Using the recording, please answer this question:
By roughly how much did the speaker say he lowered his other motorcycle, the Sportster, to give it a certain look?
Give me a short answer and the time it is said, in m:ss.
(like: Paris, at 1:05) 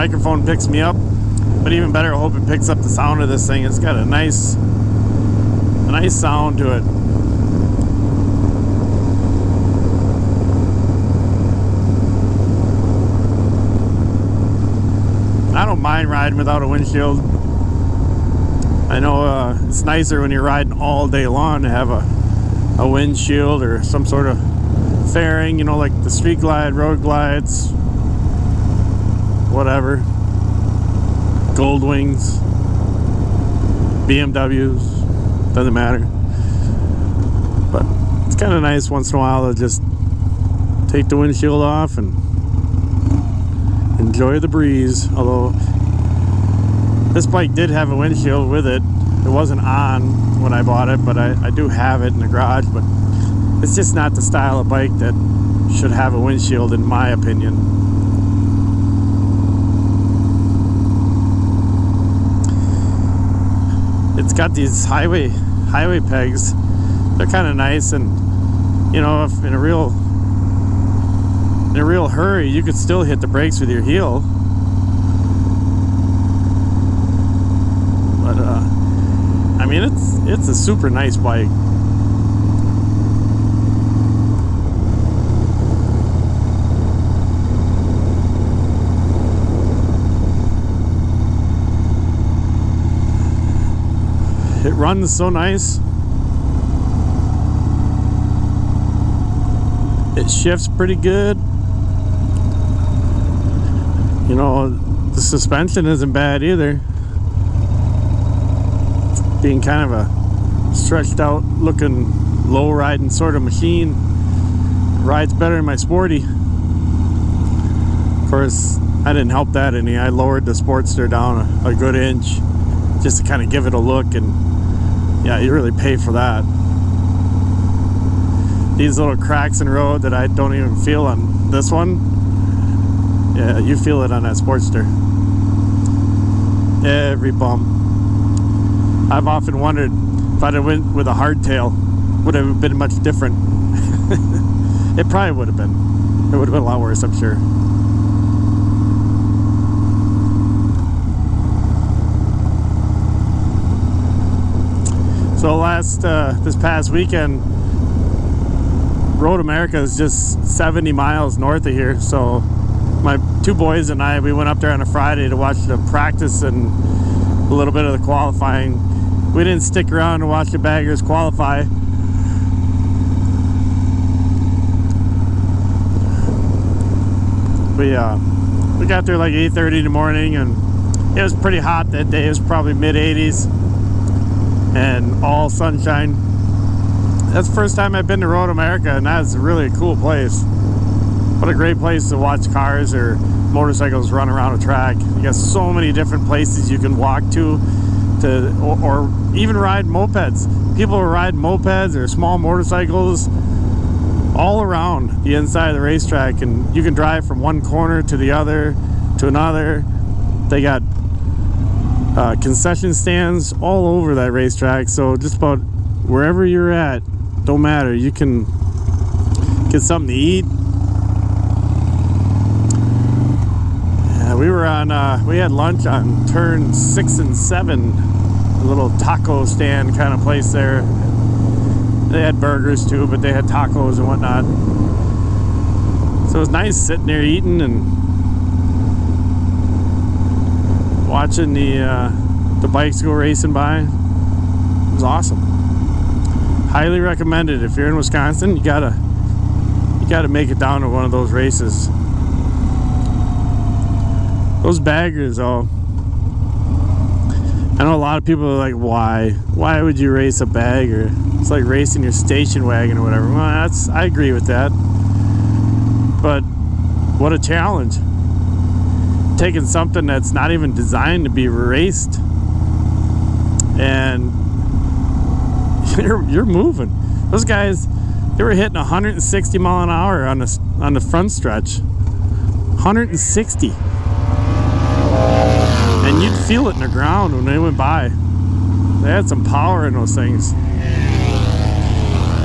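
1 inch, at 2:01.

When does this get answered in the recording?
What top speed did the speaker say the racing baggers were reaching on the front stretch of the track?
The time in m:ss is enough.
4:38.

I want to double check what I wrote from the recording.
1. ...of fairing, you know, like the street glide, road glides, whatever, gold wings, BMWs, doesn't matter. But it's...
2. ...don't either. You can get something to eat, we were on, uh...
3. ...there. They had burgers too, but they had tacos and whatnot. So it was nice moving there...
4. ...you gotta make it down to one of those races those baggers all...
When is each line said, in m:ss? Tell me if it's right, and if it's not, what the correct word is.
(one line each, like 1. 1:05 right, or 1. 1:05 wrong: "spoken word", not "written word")
1. 0:24 right
2. 3:37 wrong: "matter", not "either"
3. 3:50 wrong: "sitting", not "moving"
4. 4:09 right.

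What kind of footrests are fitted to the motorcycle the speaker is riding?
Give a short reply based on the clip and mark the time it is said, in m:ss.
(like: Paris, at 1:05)
highway pegs, at 1:05.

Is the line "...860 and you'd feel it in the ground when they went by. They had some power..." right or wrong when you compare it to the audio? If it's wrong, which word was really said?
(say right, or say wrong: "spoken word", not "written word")
wrong: "160", not "860".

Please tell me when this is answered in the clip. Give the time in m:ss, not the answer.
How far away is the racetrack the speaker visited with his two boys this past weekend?
2:40.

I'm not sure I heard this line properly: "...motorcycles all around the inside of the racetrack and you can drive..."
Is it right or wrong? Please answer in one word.
right.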